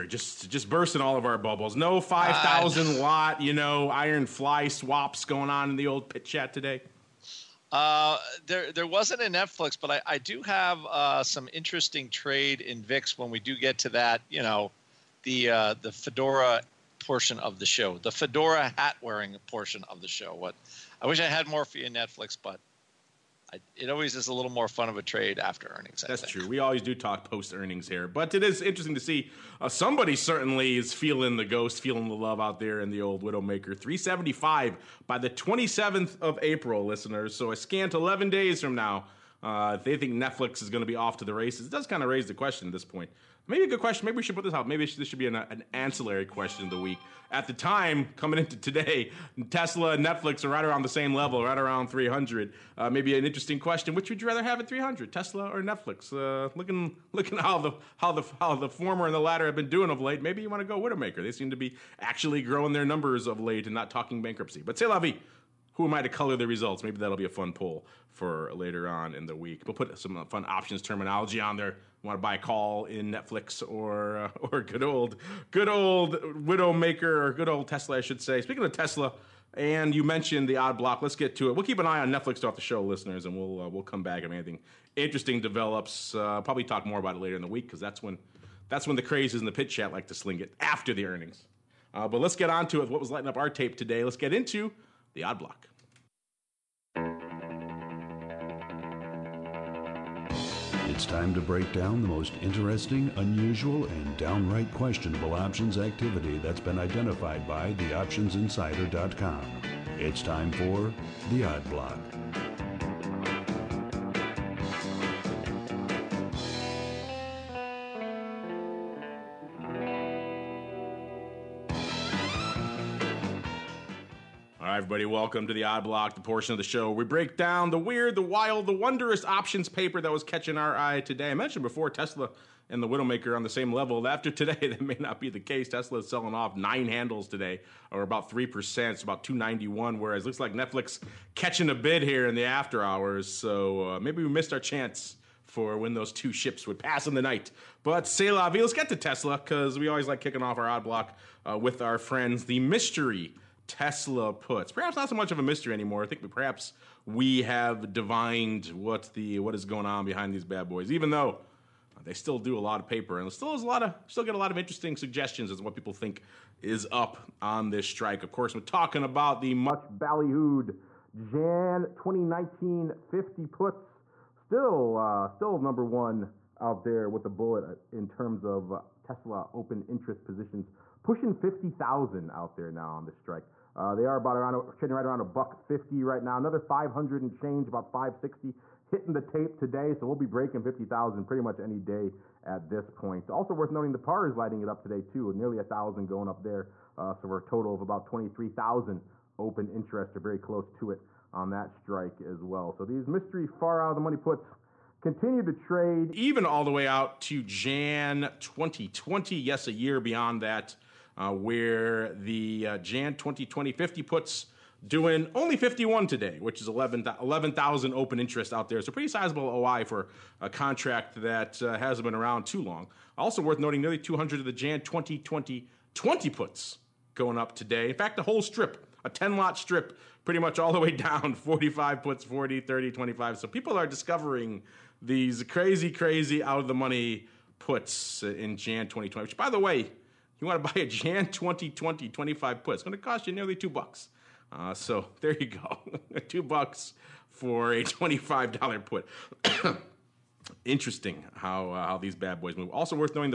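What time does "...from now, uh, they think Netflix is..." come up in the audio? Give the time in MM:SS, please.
00:38.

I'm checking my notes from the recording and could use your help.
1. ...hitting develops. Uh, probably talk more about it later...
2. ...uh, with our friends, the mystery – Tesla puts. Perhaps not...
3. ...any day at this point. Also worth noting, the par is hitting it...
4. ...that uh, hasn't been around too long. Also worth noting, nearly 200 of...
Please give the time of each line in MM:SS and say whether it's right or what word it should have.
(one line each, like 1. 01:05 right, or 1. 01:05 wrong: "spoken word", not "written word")
1. 01:24 wrong: "interesting", not "hitting"
2. 02:31 right
3. 03:11 wrong: "lighting", not "hitting"
4. 03:41 right.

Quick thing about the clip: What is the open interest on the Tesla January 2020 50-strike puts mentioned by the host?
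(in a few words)
11,000.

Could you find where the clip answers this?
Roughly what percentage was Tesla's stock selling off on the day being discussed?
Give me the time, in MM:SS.
02:18.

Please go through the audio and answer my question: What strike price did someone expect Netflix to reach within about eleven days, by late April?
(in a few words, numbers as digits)
375.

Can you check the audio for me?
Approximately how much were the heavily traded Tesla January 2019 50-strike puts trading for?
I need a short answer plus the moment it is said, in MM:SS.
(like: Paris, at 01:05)
$1.50, at 03:05.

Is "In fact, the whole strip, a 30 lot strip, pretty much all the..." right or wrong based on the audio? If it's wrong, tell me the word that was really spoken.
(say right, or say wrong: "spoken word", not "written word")
wrong: "10", not "30".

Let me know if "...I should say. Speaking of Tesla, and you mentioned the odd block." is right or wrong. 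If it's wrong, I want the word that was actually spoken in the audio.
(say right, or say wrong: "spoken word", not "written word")
right.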